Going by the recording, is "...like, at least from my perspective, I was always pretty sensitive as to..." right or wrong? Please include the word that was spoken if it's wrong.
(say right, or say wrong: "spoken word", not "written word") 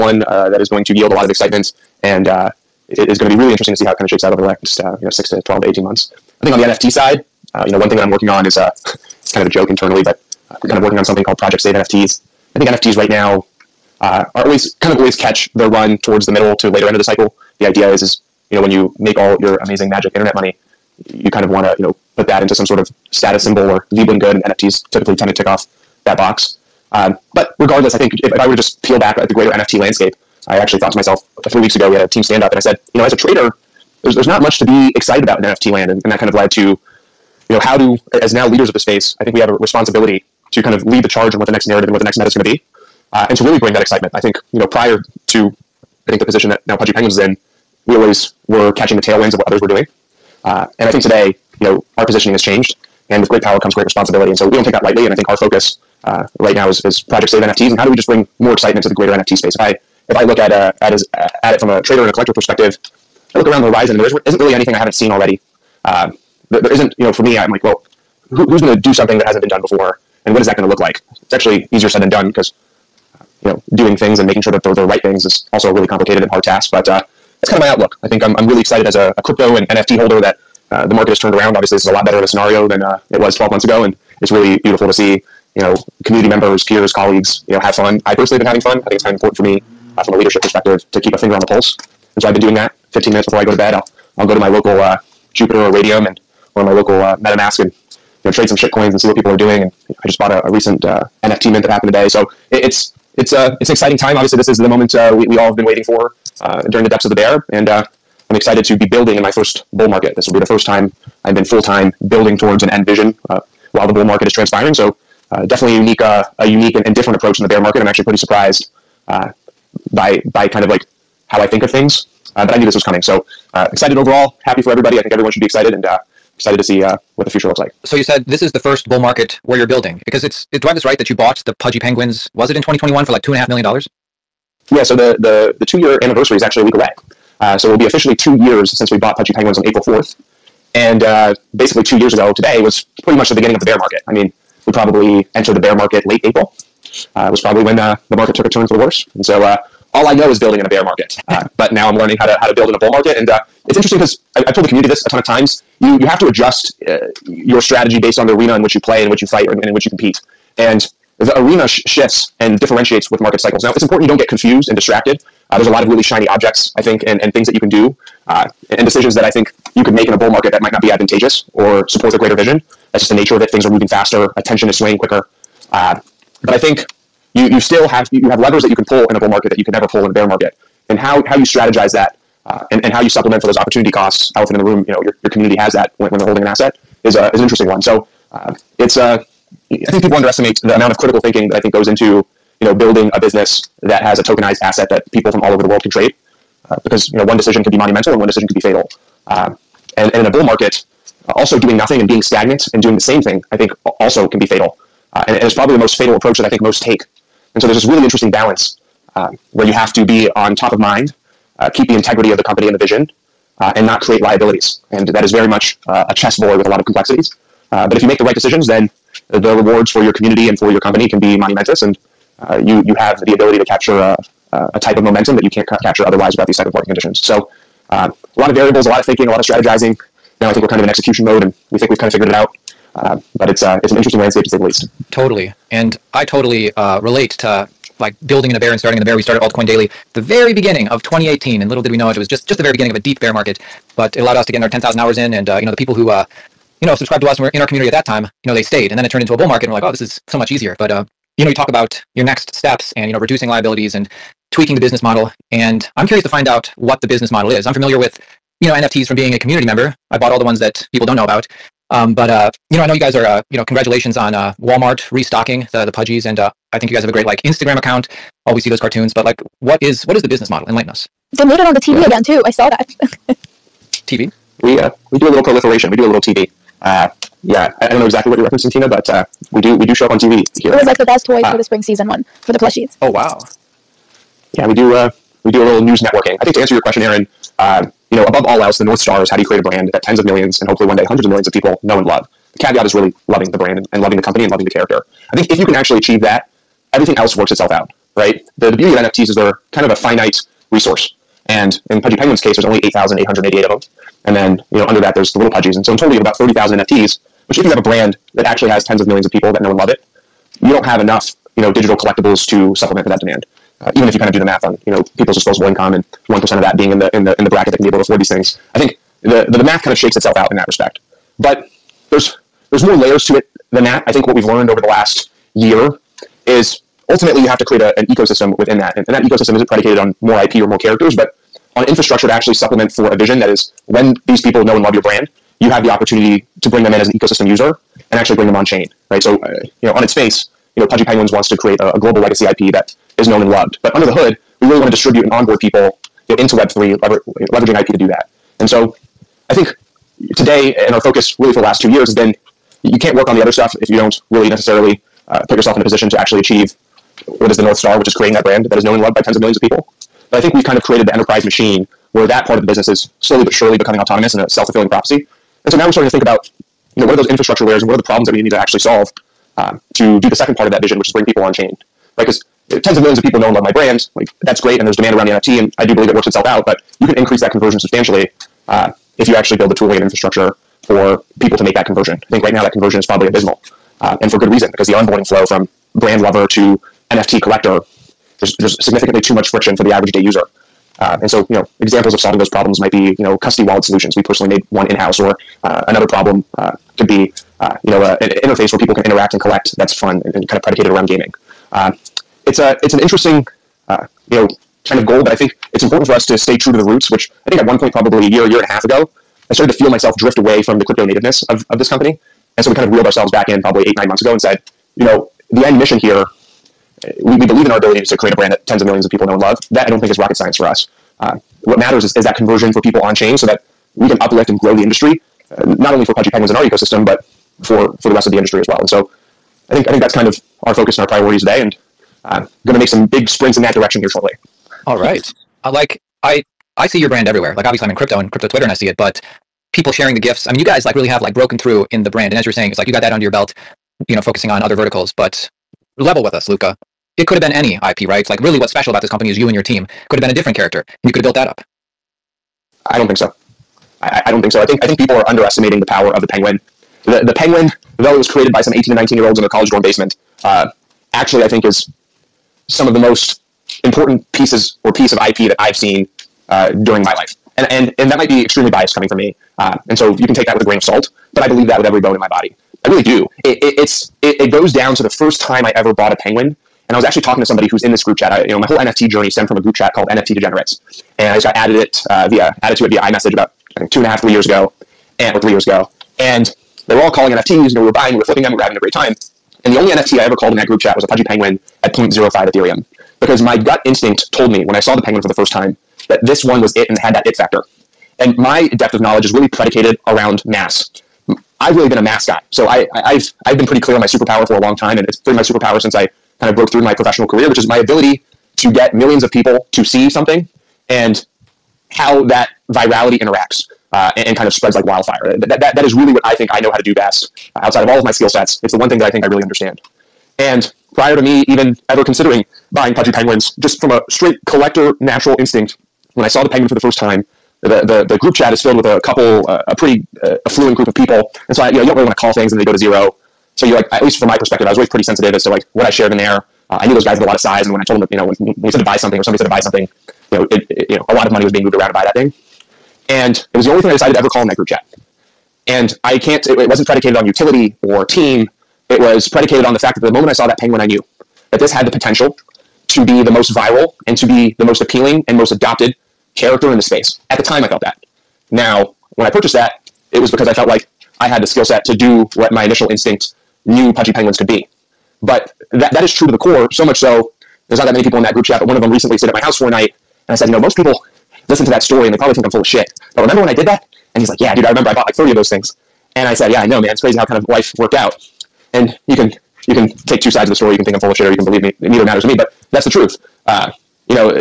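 right.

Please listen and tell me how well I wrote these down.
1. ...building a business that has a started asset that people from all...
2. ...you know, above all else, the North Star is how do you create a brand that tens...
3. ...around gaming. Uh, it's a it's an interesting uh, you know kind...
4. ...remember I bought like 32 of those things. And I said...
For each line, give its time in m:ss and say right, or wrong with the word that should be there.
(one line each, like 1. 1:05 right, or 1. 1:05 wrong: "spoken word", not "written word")
1. 3:12 wrong: "tokenized", not "started"
2. 4:48 right
3. 6:40 right
4. 9:34 wrong: "30", not "32".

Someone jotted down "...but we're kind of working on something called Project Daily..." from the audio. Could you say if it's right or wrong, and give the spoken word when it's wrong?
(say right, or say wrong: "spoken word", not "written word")
wrong: "Save", not "Daily".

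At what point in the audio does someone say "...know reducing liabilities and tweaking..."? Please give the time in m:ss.
4:13.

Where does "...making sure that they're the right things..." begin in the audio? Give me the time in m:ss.
1:14.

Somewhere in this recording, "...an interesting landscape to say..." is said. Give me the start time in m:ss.
3:53.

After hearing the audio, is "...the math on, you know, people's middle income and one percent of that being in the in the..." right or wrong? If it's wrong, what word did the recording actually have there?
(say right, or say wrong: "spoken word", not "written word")
wrong: "disposable", not "middle".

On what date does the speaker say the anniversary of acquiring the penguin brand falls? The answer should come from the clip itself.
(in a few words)
April 4.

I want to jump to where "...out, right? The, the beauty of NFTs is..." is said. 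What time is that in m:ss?
4:57.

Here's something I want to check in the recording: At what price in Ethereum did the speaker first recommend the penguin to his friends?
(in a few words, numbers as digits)
0.05 ETH.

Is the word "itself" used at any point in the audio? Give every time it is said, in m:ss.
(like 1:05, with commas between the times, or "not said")
4:57, 5:20, 6:16.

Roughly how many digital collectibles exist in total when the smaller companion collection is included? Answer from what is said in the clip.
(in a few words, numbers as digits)
30,000.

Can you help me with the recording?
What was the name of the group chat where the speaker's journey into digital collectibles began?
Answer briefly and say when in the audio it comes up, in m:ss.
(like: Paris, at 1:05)
NFT Degenerates, at 8:00.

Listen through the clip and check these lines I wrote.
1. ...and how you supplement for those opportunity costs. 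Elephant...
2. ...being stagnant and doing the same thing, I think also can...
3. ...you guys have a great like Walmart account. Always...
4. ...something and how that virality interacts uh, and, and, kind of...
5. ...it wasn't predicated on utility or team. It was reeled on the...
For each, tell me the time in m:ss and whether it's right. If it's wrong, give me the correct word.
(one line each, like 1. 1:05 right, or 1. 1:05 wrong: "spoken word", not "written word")
1. 3:02 right
2. 3:22 right
3. 4:26 wrong: "Instagram", not "Walmart"
4. 8:30 right
5. 9:06 wrong: "predicated", not "reeled".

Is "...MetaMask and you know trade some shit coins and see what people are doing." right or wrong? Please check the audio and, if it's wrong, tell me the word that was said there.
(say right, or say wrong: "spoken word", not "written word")
right.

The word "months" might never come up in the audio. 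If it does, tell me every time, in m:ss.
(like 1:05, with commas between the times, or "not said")
0:05, 1:23, 6:54.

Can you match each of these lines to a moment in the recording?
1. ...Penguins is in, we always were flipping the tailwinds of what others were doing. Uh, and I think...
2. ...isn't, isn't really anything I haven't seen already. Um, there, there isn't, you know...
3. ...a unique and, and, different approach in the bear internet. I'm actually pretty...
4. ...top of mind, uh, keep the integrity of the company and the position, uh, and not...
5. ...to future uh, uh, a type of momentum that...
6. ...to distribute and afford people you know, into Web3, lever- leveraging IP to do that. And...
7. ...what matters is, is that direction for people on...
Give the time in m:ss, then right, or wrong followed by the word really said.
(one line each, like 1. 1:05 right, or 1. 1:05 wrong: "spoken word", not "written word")
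1. 0:46 wrong: "catching", not "flipping"
2. 1:04 right
3. 1:56 wrong: "market", not "internet"
4. 3:30 wrong: "vision", not "position"
5. 3:43 wrong: "capture", not "future"
6. 5:44 wrong: "onboard", not "afford"
7. 7:01 wrong: "conversion", not "direction".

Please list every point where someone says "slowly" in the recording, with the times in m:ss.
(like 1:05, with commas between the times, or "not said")
6:03.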